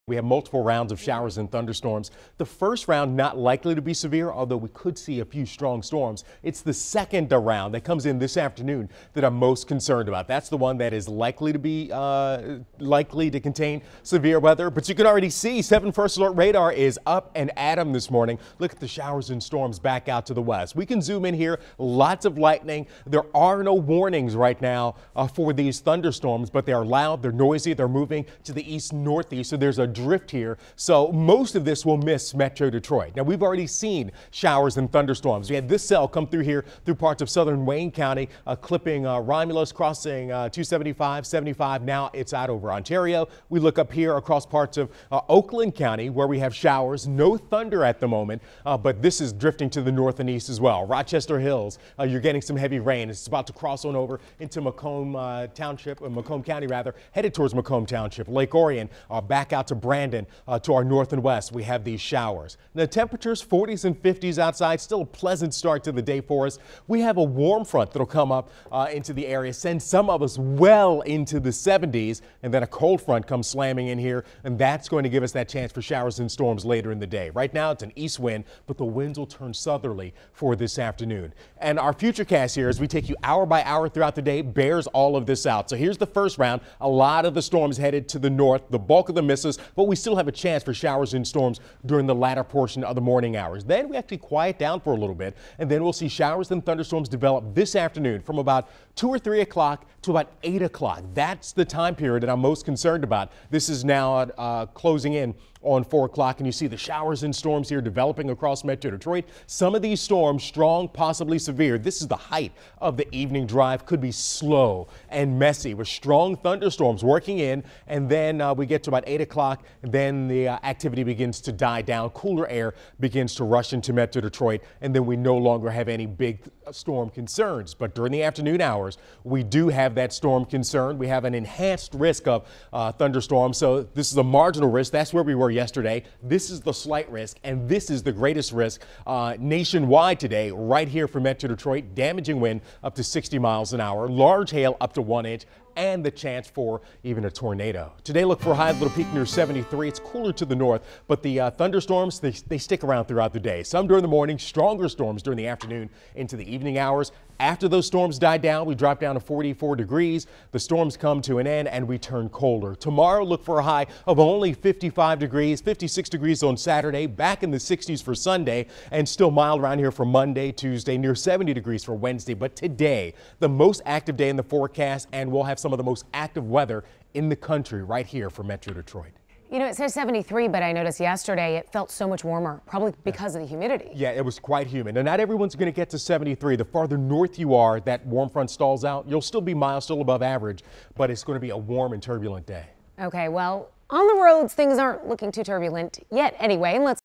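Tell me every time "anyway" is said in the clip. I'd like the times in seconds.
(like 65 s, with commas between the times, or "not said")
196 s.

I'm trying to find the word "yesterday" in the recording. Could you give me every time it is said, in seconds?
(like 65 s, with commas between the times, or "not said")
135 s, 181 s.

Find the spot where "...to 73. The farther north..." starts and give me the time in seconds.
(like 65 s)
185 s.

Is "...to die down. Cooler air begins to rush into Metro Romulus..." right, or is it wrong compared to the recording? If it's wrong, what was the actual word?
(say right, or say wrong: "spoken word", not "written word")
wrong: "Detroit", not "Romulus".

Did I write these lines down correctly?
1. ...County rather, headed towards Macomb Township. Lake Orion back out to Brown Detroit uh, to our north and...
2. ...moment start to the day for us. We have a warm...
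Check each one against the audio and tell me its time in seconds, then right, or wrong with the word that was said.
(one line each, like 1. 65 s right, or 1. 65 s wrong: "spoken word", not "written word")
1. 56 s wrong: "Brandon", not "Detroit"
2. 65 s wrong: "pleasant", not "moment".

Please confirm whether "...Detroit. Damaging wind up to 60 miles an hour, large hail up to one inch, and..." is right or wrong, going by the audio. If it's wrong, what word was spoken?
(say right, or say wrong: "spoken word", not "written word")
right.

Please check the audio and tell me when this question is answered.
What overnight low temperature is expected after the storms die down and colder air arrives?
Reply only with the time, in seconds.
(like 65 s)
159 s.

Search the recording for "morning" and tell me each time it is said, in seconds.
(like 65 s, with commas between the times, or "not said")
18 s, 93 s, 154 s.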